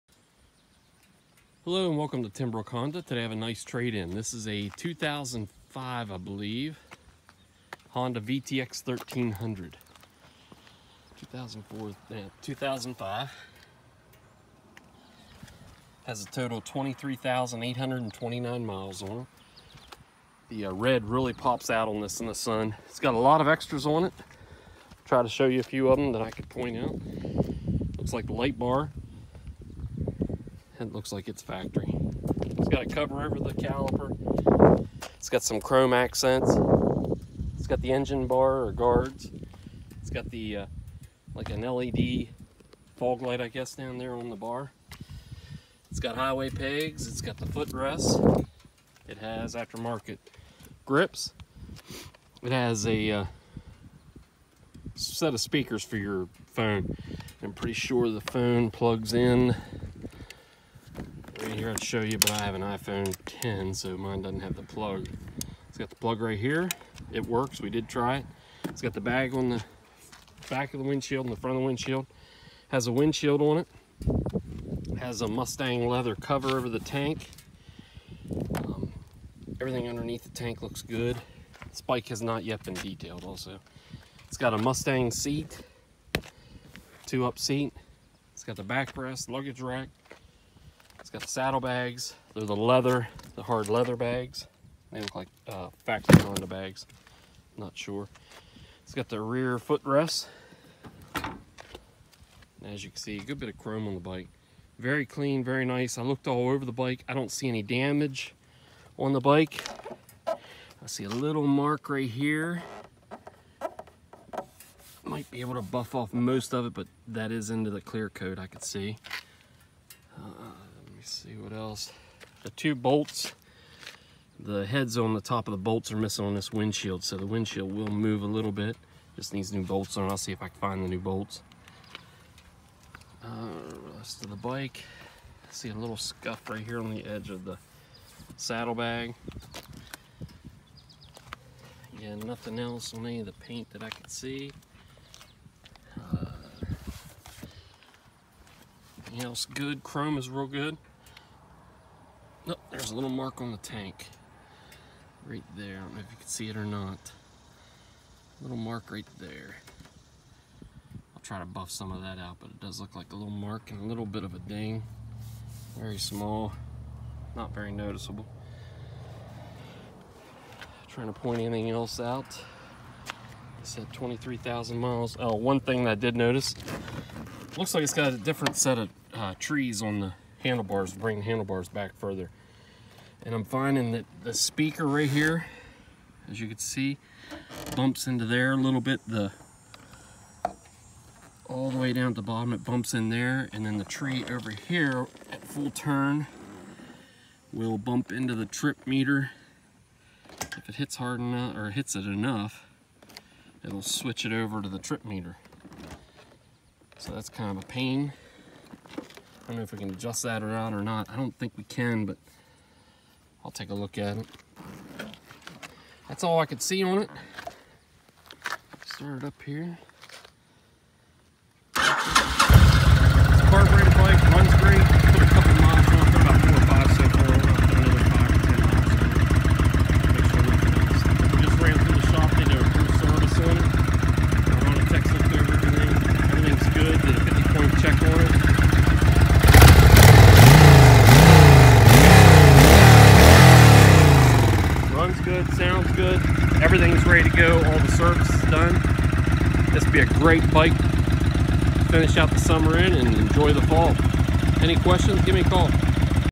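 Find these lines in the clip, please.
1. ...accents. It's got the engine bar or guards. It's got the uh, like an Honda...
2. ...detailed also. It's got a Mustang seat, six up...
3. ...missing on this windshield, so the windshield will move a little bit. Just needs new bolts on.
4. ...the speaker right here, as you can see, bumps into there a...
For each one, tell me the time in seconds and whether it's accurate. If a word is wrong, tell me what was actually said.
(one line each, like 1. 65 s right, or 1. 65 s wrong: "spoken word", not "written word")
1. 35 s wrong: "LED", not "Honda"
2. 82 s wrong: "two", not "six"
3. 125 s right
4. 184 s right.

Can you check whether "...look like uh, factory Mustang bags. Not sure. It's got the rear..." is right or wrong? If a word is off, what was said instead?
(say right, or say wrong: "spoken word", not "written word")
wrong: "Honda", not "Mustang".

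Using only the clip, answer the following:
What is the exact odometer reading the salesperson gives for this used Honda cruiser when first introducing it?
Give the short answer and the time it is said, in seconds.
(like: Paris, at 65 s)
23,829 miles, at 16 s.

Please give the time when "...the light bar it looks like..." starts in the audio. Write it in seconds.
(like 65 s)
28 s.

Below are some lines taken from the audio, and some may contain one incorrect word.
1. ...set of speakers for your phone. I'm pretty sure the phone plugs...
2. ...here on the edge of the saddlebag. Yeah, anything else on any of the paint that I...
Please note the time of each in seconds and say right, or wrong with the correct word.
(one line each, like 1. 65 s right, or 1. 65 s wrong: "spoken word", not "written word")
1. 54 s right
2. 136 s wrong: "nothing", not "anything".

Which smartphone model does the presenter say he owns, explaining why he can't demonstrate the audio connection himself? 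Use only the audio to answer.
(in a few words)
iPhone 10.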